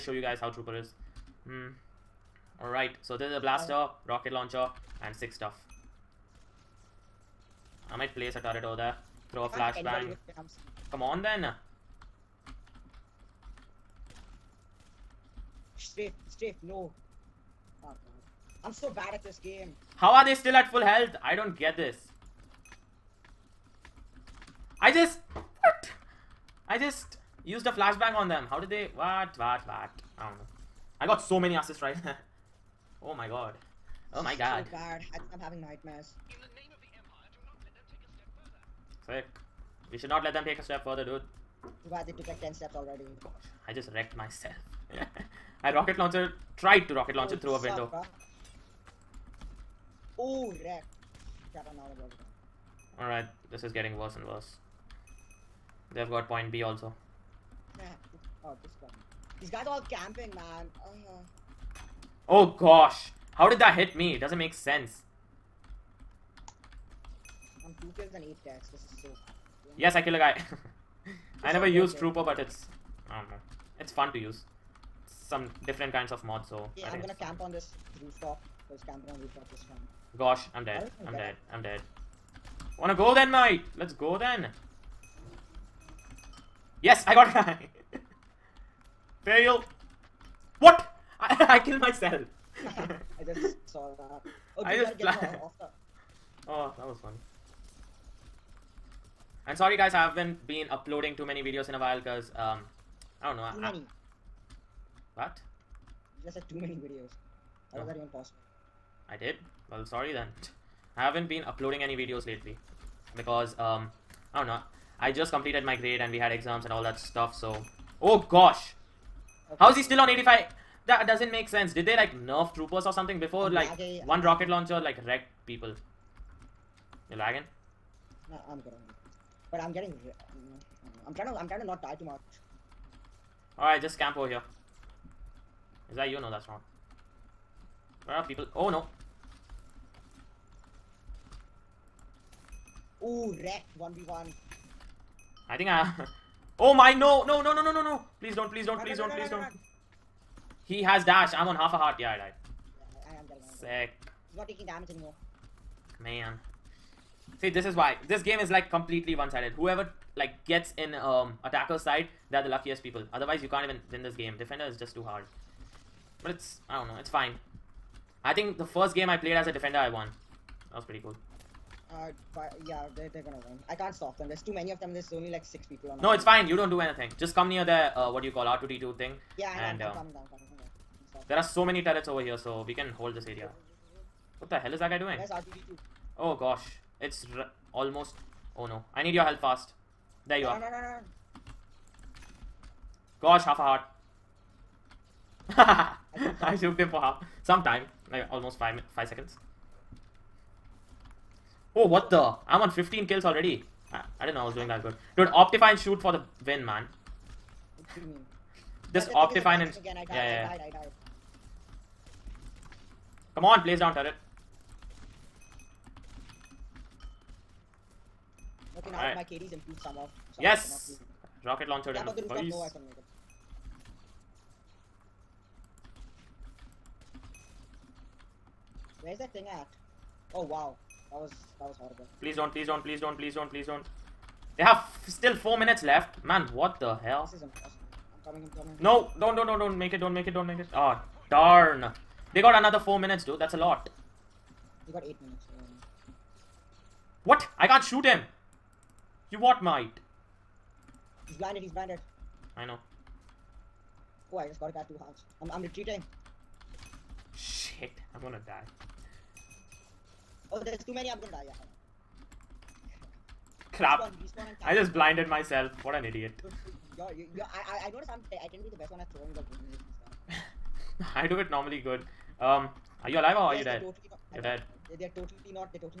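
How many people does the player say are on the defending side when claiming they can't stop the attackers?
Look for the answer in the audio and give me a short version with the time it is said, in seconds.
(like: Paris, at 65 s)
6, at 175 s.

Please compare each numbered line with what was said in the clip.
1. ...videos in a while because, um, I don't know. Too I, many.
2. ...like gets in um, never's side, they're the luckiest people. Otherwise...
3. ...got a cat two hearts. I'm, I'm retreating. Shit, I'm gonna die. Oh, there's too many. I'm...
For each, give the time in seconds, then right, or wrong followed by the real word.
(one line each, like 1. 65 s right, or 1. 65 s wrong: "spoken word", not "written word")
1. 101 s right
2. 160 s wrong: "attacker", not "never"
3. 254 s right.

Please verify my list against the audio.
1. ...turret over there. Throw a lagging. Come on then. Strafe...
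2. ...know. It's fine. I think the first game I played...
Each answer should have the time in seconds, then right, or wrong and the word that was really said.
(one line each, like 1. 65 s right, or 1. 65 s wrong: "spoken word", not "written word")
1. 8 s wrong: "flashbang", not "lagging"
2. 166 s right.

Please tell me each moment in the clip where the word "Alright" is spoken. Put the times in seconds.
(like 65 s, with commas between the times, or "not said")
2 s, 52 s, 133 s.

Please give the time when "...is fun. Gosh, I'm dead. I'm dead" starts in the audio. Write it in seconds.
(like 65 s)
79 s.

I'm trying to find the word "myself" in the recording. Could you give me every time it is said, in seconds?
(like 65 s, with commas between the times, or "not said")
44 s, 91 s, 265 s.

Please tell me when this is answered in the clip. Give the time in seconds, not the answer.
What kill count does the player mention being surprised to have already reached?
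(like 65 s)
202 s.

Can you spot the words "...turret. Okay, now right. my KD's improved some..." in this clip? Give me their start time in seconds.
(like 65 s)
213 s.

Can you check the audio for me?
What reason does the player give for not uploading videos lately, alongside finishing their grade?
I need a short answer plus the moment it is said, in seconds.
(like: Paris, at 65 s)
exams, at 116 s.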